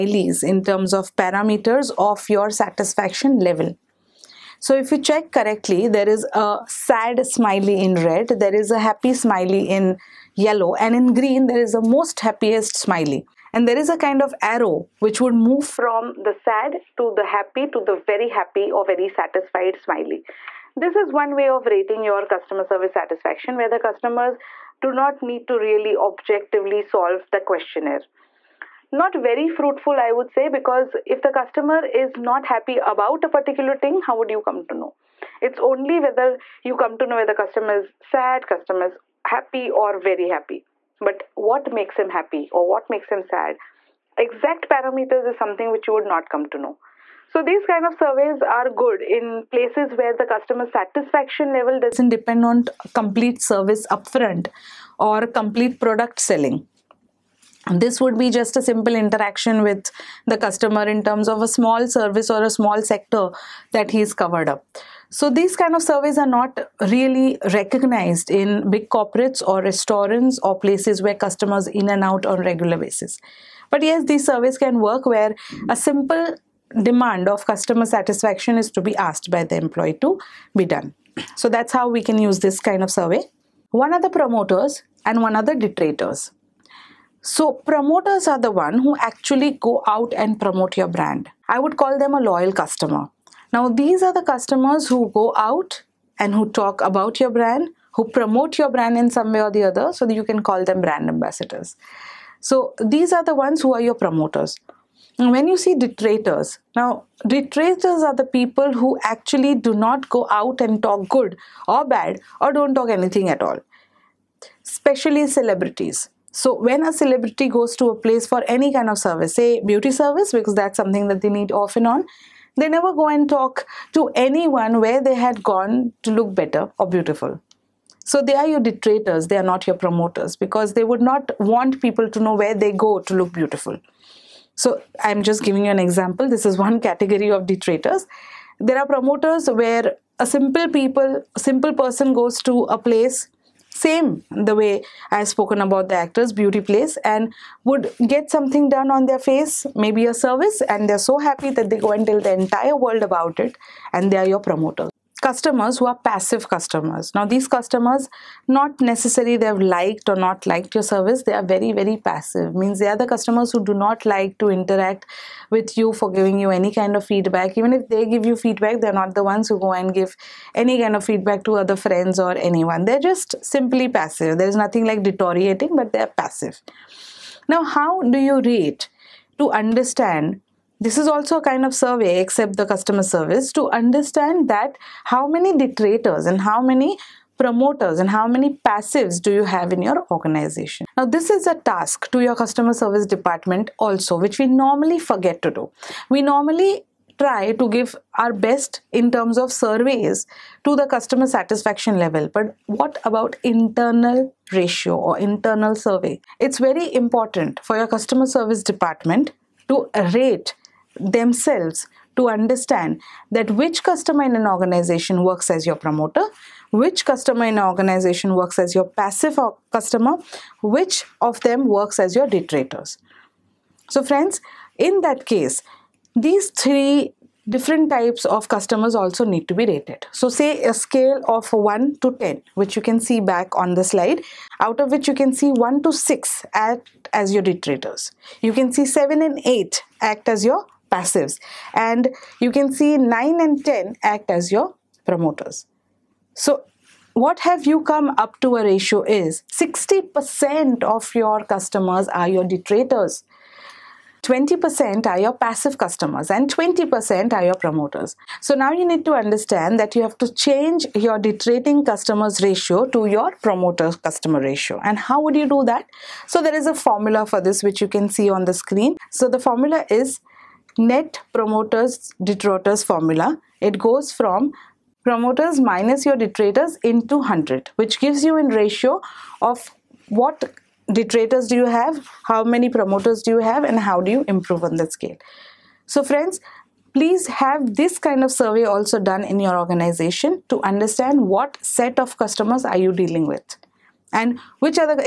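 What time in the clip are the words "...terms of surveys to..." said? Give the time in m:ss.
3:19.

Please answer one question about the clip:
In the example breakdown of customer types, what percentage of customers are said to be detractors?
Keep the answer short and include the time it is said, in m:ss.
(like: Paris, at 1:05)
60%, at 4:09.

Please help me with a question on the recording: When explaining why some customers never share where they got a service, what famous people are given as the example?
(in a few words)
celebrities.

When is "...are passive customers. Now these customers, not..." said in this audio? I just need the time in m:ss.
2:35.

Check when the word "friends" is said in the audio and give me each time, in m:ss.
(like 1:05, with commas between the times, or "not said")
2:51, 3:44, 4:46.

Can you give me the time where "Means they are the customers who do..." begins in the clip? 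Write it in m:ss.
2:42.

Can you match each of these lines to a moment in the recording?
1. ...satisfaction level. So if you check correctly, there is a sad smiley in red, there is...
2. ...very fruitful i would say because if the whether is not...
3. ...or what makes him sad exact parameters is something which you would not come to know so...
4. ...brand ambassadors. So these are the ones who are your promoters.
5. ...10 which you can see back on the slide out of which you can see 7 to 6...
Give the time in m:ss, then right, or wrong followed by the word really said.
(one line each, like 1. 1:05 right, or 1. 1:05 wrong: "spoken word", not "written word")
1. 0:02 right
2. 0:29 wrong: "customer", not "whether"
3. 0:42 right
4. 1:40 right
5. 3:52 wrong: "1", not "7".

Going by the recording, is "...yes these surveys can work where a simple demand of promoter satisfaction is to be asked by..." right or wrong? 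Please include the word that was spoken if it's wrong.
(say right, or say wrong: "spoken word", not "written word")
wrong: "customer", not "promoter".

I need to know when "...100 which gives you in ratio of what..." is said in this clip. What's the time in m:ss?
4:37.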